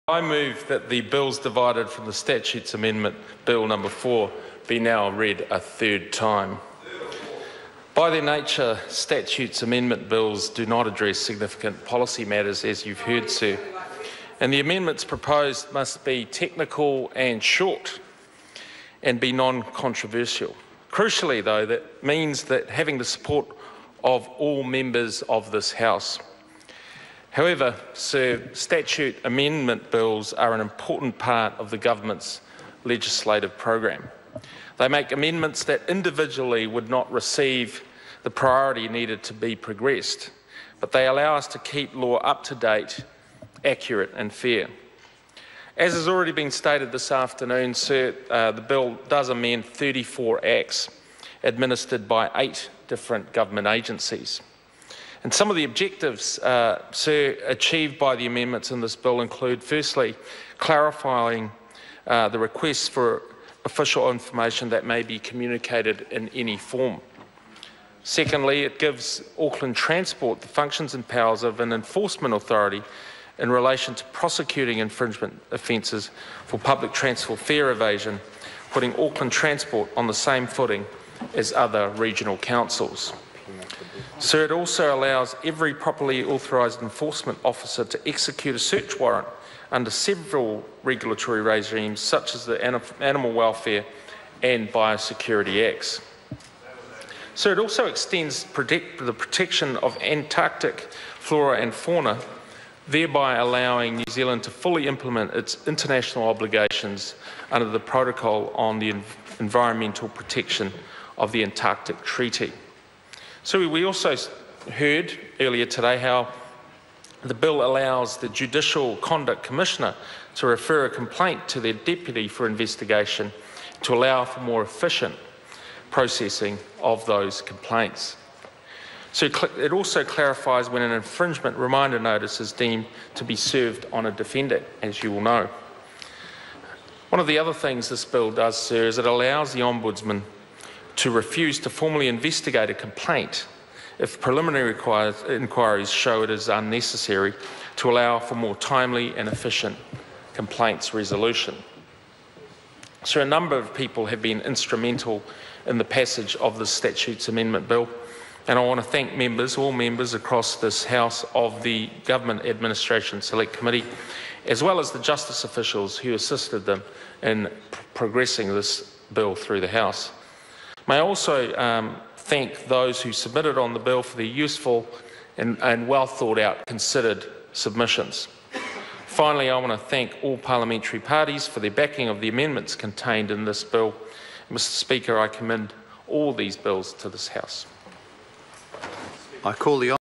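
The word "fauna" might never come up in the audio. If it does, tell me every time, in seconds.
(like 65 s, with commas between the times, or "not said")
101 s.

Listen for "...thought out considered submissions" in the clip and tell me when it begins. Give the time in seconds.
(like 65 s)
176 s.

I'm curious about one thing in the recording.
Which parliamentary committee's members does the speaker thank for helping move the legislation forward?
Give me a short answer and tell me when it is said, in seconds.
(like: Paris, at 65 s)
Government Administration Select Committee, at 162 s.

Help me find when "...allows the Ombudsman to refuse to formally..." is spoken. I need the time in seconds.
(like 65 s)
139 s.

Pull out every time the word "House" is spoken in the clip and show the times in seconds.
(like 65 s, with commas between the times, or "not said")
25 s, 160 s, 169 s, 187 s.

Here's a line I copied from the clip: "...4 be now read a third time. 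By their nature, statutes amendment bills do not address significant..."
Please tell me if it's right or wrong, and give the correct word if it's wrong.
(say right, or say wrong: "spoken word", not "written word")
right.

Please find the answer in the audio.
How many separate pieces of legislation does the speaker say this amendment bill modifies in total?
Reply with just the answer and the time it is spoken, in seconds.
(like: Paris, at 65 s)
34, at 49 s.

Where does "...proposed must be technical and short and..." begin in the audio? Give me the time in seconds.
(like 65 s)
15 s.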